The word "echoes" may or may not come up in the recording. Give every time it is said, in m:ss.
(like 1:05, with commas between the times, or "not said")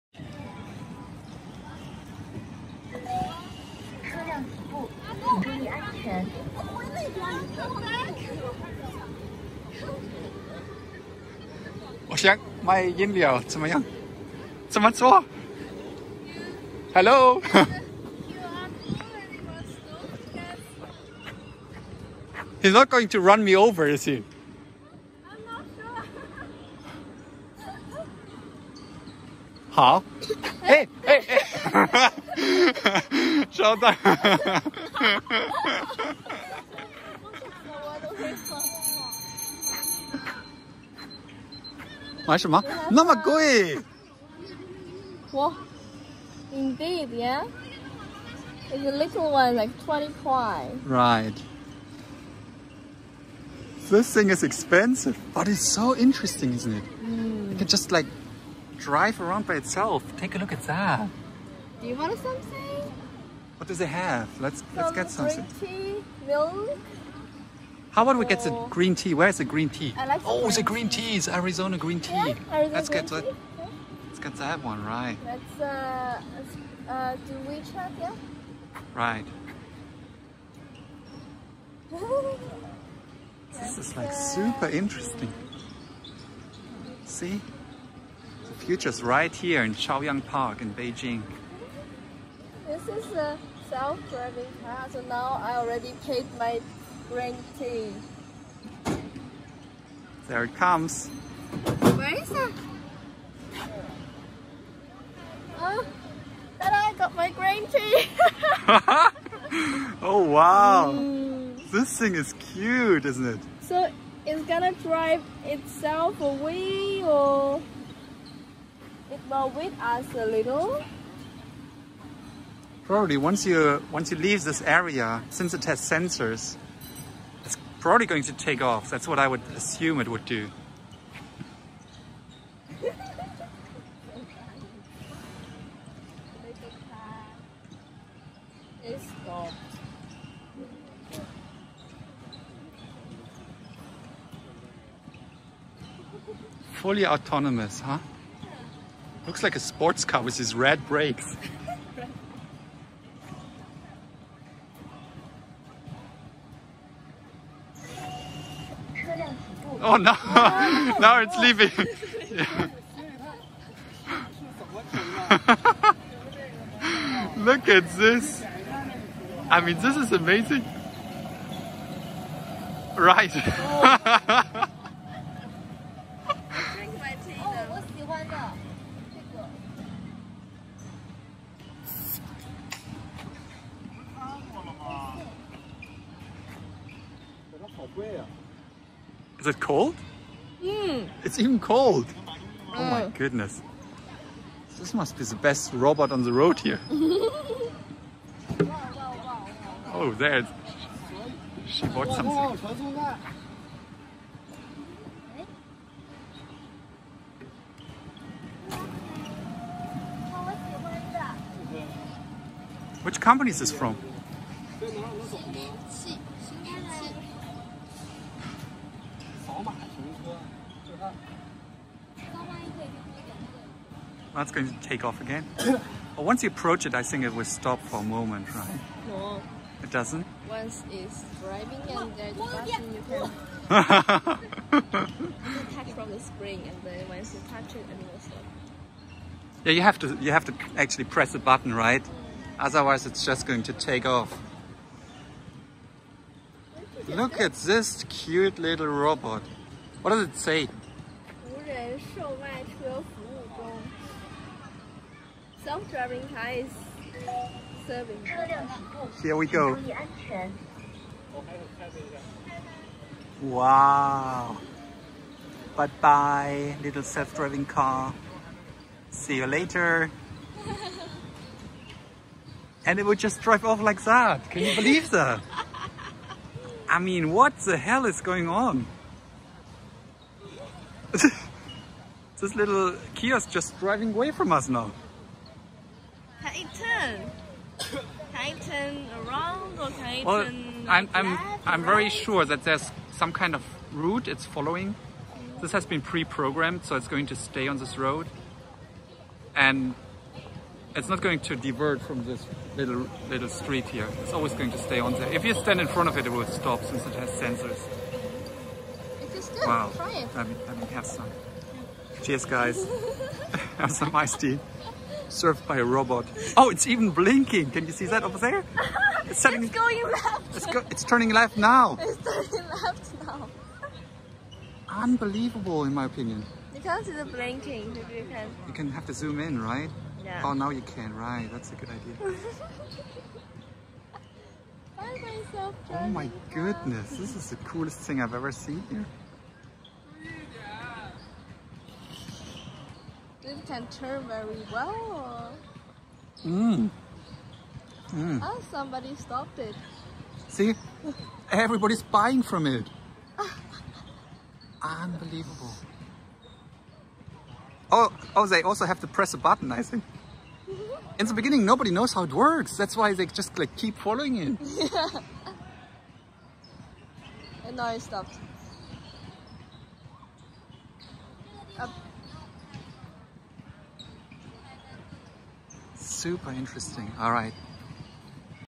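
not said.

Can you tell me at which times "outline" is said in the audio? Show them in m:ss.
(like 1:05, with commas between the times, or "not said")
not said.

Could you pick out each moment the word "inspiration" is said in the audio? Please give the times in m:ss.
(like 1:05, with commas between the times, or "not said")
not said.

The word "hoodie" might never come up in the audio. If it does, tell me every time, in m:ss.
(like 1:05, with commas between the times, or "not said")
not said.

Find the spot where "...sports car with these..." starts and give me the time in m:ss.
2:29.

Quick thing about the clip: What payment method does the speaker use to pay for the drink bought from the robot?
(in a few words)
WeChat.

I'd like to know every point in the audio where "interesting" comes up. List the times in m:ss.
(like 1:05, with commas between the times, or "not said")
0:55, 1:24, 6:16.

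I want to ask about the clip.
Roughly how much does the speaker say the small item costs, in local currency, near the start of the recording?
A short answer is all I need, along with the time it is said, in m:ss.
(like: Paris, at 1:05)
20 kuai, at 0:49.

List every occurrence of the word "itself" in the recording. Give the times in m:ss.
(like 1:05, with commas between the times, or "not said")
0:59, 1:55.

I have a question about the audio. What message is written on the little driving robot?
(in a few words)
Self-driving car is serving.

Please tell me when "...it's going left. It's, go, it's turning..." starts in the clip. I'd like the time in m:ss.
5:19.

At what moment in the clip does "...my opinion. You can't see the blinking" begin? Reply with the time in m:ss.
5:25.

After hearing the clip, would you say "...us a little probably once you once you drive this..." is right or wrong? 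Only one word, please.
wrong.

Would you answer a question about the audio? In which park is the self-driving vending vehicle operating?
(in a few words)
Chaoyang Park.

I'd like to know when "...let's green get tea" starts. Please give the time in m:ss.
1:12.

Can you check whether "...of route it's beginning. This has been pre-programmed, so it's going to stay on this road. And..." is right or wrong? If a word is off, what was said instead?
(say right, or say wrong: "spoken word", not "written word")
wrong: "following", not "beginning".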